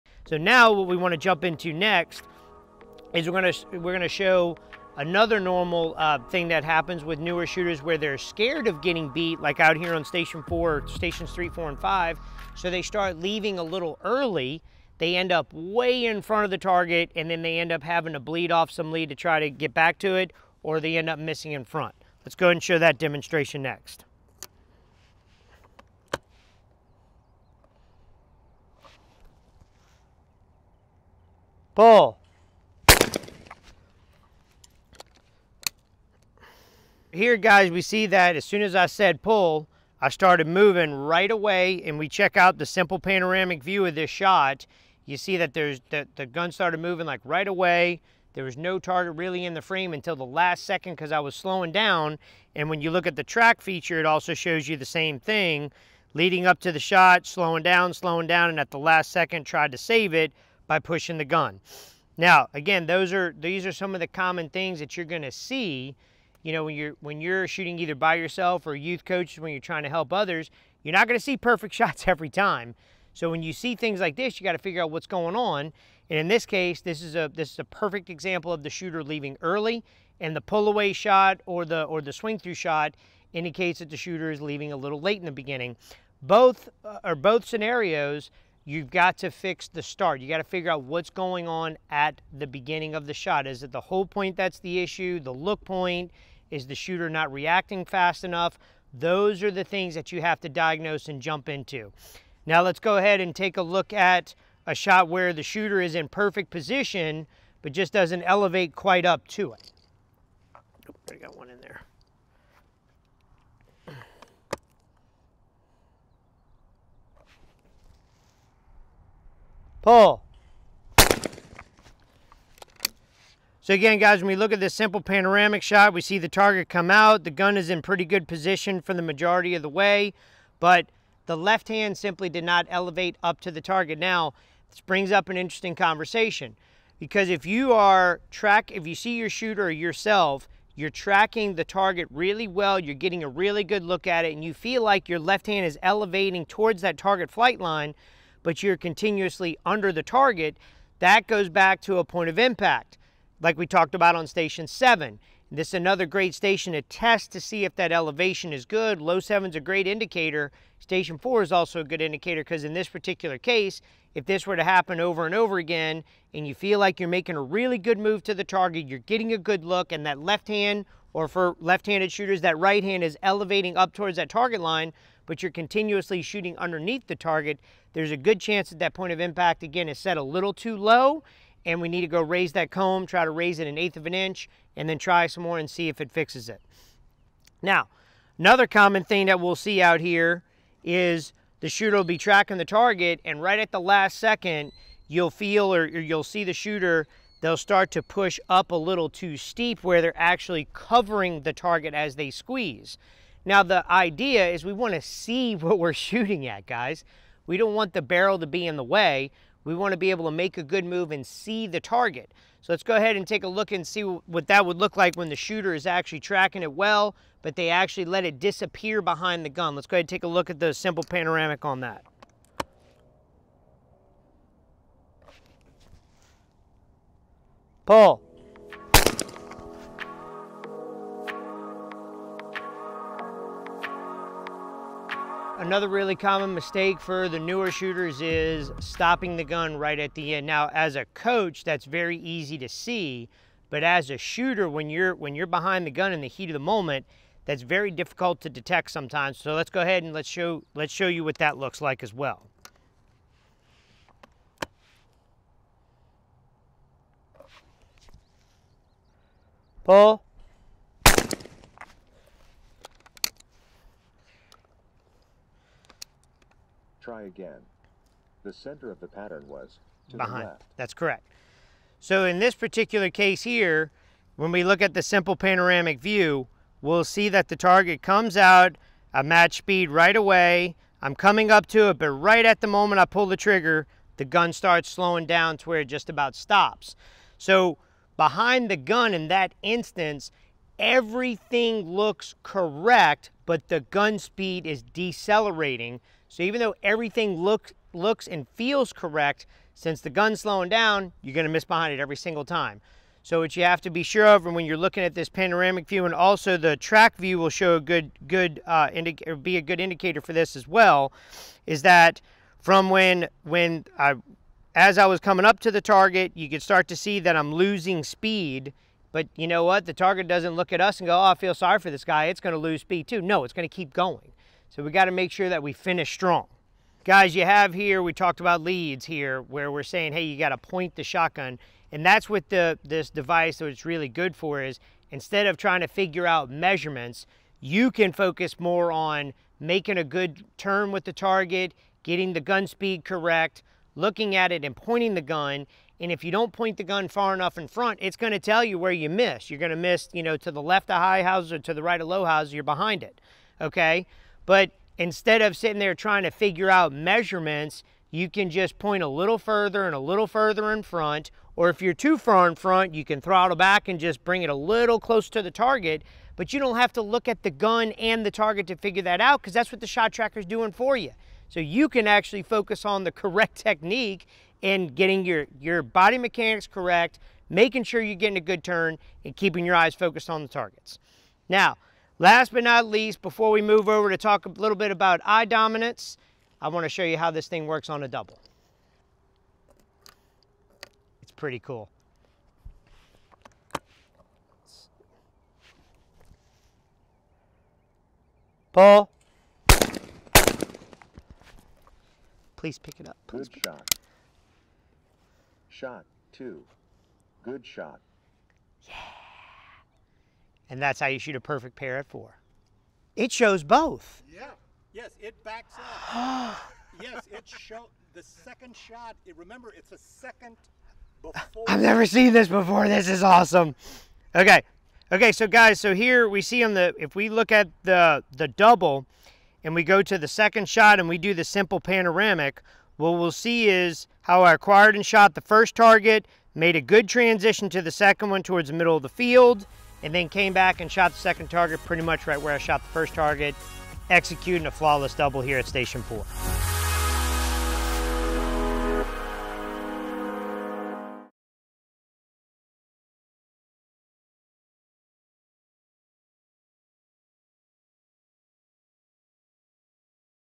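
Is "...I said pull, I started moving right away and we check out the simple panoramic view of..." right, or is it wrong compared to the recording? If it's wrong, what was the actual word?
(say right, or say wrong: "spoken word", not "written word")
right.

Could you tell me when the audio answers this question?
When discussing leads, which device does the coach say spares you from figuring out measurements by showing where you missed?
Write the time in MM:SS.
06:09.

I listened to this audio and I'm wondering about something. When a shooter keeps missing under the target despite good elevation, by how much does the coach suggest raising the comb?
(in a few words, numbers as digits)
an eighth of an inch.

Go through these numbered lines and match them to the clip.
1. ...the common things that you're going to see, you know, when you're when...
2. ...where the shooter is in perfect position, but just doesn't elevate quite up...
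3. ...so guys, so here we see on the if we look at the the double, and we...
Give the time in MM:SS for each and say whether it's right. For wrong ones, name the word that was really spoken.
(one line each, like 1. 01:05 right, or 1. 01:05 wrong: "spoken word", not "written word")
1. 01:03 right
2. 01:45 right
3. 07:05 right.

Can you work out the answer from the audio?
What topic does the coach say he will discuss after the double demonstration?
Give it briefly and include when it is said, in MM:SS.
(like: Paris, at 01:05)
eye dominance, at 06:25.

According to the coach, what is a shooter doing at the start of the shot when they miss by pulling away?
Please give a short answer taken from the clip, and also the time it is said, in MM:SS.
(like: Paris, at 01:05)
leaving a little late, at 01:24.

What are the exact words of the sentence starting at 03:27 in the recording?
We don't want the barrel to be in the way.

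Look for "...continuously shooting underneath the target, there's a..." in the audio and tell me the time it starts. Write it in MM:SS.
02:55.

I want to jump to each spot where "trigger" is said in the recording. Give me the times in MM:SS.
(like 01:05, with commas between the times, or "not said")
04:43.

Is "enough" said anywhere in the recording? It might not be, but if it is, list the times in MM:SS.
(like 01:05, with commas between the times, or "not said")
01:38, 05:47.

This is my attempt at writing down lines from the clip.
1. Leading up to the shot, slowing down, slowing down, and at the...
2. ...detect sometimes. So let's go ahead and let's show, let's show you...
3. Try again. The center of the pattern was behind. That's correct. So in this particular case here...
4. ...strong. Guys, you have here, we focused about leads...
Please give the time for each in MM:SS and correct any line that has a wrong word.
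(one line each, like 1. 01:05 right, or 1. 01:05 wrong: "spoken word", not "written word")
1. 00:56 right
2. 04:08 right
3. 04:27 right
4. 05:26 wrong: "talked", not "focused".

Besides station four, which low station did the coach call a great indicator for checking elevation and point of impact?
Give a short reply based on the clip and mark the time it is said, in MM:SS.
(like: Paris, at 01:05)
Low seven, at 02:39.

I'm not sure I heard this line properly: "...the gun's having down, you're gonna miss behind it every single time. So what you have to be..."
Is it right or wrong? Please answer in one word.
wrong.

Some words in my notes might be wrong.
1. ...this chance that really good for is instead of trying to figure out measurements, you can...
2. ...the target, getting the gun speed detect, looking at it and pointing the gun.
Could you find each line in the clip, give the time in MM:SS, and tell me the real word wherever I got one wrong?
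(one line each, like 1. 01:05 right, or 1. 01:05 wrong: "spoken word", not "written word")
1. 05:32 wrong: "device", not "chance"
2. 05:41 wrong: "correct", not "detect".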